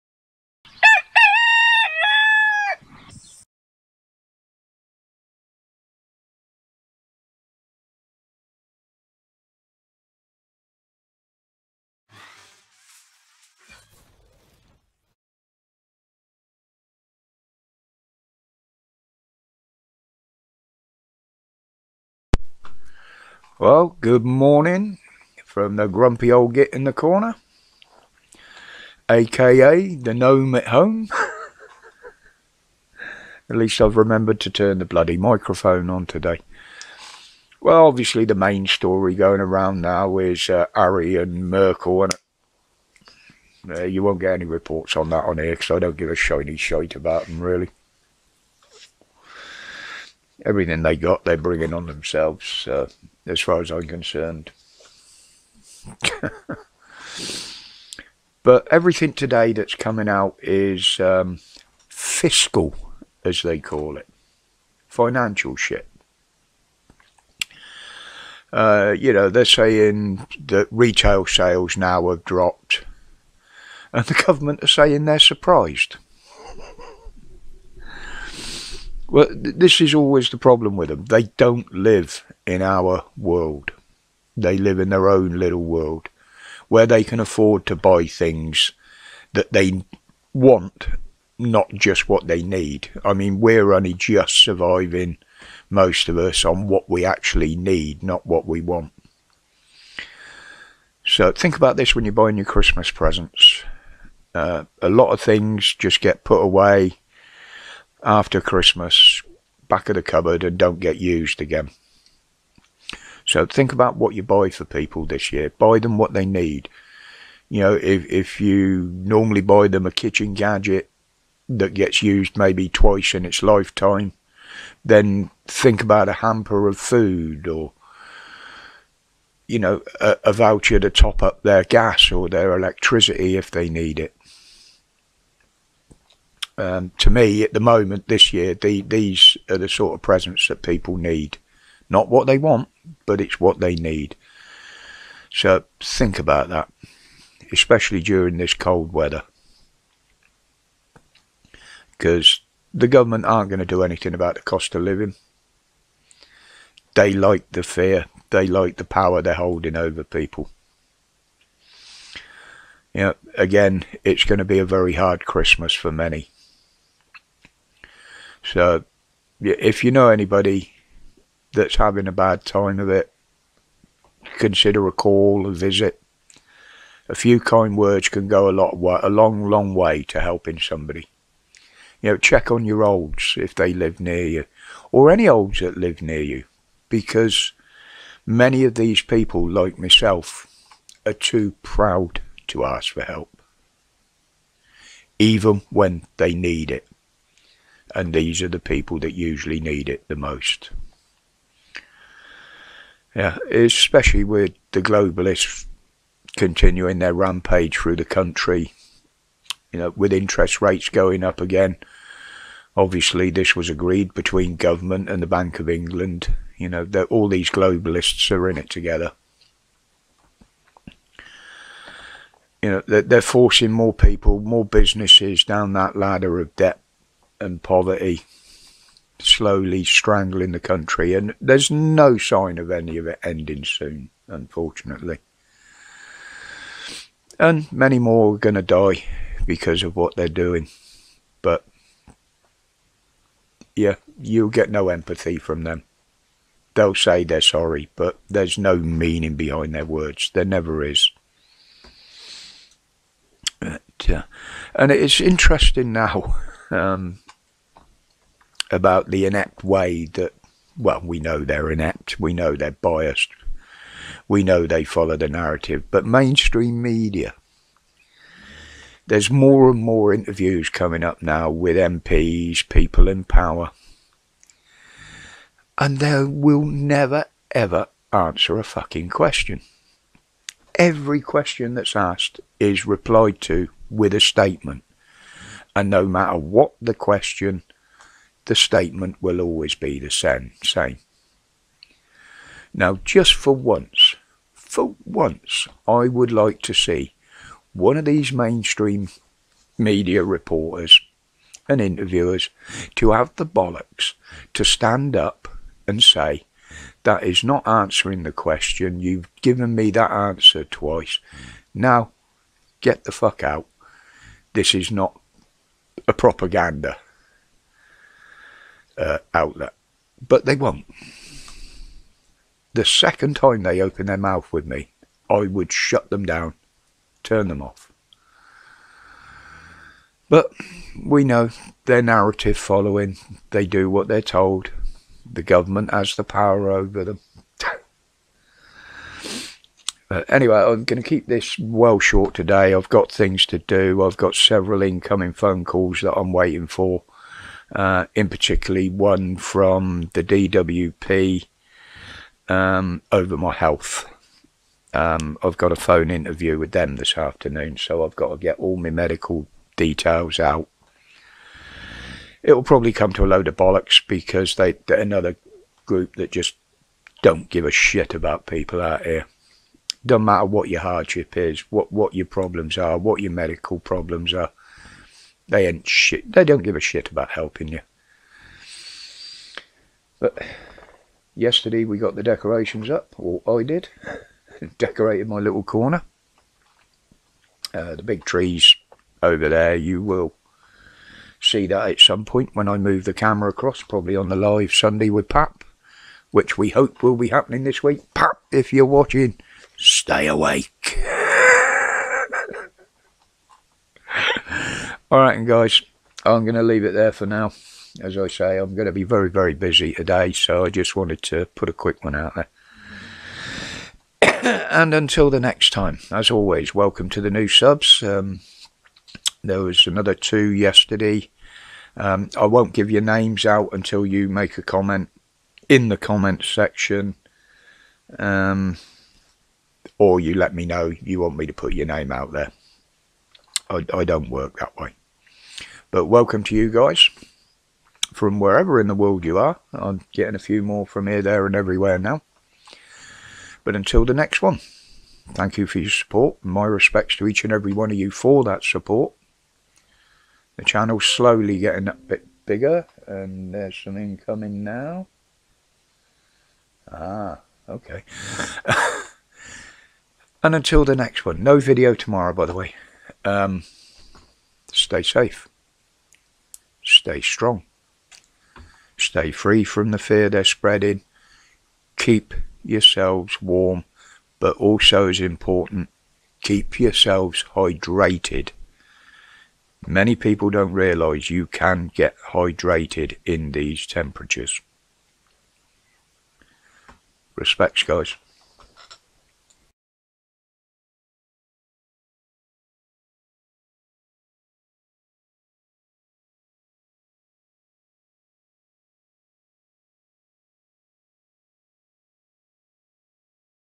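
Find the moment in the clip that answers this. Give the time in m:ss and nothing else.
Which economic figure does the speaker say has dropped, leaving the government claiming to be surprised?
1:10.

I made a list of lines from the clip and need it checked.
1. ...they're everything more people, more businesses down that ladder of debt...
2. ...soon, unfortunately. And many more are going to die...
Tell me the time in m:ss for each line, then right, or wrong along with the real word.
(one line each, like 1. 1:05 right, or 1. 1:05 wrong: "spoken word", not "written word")
1. 3:43 wrong: "forcing", not "everything"
2. 3:53 right.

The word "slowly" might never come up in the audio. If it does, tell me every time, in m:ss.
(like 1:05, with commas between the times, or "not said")
3:49, 7:31.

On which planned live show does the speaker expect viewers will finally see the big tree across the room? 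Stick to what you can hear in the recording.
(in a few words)
The live Sunday with Pap.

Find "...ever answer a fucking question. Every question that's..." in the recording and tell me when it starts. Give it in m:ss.
4:37.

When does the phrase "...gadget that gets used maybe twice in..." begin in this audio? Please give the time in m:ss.
2:00.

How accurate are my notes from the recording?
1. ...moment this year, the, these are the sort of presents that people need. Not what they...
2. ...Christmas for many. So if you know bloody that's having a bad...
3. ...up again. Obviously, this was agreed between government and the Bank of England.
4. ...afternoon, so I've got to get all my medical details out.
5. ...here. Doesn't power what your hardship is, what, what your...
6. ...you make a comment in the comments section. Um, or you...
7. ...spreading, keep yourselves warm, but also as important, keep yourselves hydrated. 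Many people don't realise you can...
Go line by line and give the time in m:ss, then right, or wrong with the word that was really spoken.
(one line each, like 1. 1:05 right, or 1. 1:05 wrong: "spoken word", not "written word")
1. 2:17 right
2. 2:45 wrong: "anybody", not "bloody"
3. 3:31 right
4. 5:57 right
5. 6:09 wrong: "matter", not "power"
6. 7:04 right
7. 7:50 right.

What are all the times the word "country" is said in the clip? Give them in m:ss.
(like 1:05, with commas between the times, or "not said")
3:28, 3:50.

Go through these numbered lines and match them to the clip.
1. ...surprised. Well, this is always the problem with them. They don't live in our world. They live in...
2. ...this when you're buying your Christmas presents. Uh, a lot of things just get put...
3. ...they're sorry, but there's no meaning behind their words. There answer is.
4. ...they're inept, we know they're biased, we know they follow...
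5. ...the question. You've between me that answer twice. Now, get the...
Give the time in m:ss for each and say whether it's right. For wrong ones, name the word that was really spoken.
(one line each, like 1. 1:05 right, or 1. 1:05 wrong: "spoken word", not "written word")
1. 1:15 right
2. 1:41 right
3. 4:07 wrong: "never", not "answer"
4. 4:21 right
5. 5:08 wrong: "given", not "between".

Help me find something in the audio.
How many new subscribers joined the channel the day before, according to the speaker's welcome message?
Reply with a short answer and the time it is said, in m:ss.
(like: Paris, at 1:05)
2, at 7:00.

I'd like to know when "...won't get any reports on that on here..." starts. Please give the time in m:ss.
0:44.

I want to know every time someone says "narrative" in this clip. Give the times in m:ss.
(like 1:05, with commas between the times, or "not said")
4:25, 5:32.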